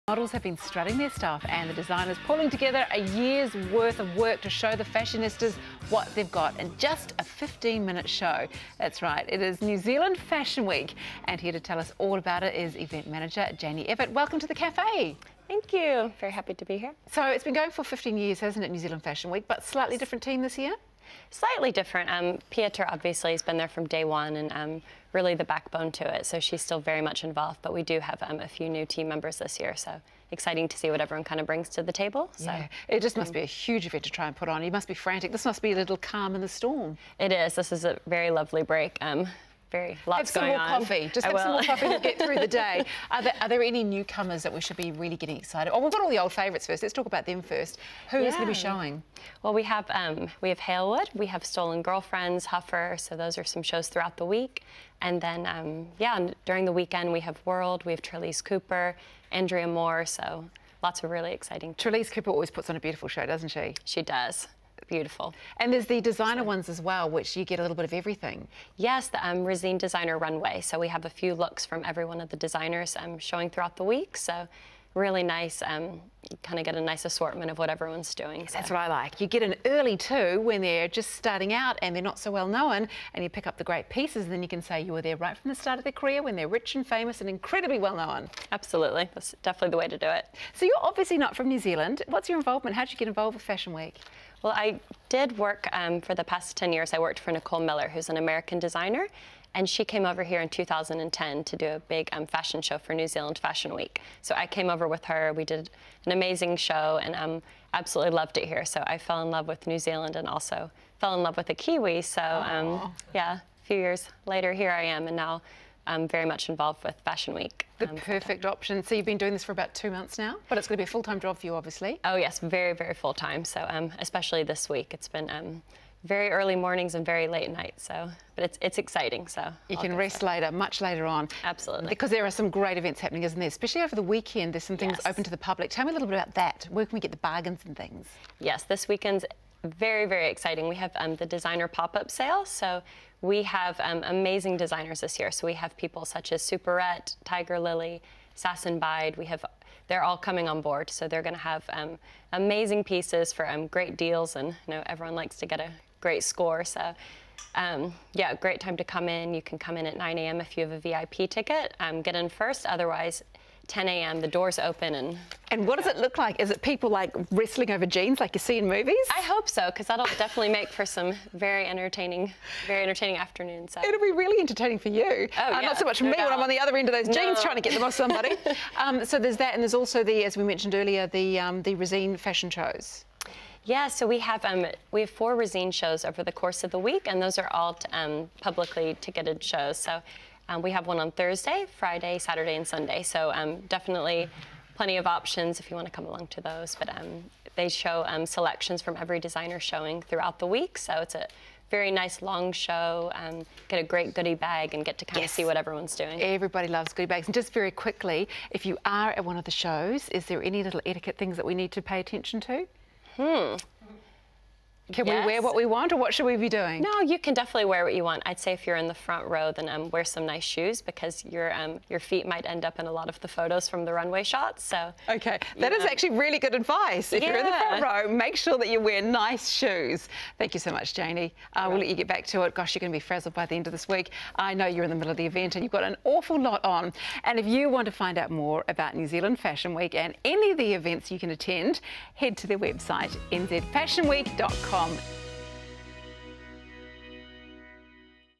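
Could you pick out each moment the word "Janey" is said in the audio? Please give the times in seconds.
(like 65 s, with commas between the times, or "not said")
13 s, 230 s.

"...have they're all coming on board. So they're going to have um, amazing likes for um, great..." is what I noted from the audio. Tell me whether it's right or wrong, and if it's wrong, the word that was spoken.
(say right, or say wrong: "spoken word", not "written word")
wrong: "pieces", not "likes".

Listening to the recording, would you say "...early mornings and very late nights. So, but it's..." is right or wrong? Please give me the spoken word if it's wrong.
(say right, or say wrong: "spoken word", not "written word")
right.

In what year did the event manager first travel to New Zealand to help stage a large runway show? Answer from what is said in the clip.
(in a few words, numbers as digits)
2010.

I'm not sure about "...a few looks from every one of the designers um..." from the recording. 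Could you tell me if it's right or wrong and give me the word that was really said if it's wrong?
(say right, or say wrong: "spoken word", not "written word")
right.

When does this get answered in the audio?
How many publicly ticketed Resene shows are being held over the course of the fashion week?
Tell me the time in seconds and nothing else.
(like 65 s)
185 s.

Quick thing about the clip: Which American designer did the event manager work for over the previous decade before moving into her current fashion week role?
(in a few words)
Nicole Miller.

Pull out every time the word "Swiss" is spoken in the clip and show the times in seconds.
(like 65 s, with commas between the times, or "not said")
not said.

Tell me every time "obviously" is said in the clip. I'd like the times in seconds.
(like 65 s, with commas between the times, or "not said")
22 s, 90 s, 121 s.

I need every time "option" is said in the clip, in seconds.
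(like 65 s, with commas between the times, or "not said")
118 s, 195 s.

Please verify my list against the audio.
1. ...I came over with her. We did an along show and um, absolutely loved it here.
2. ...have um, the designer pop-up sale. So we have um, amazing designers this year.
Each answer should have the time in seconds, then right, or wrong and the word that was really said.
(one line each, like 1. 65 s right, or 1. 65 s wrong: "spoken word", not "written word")
1. 104 s wrong: "amazing", not "along"
2. 140 s right.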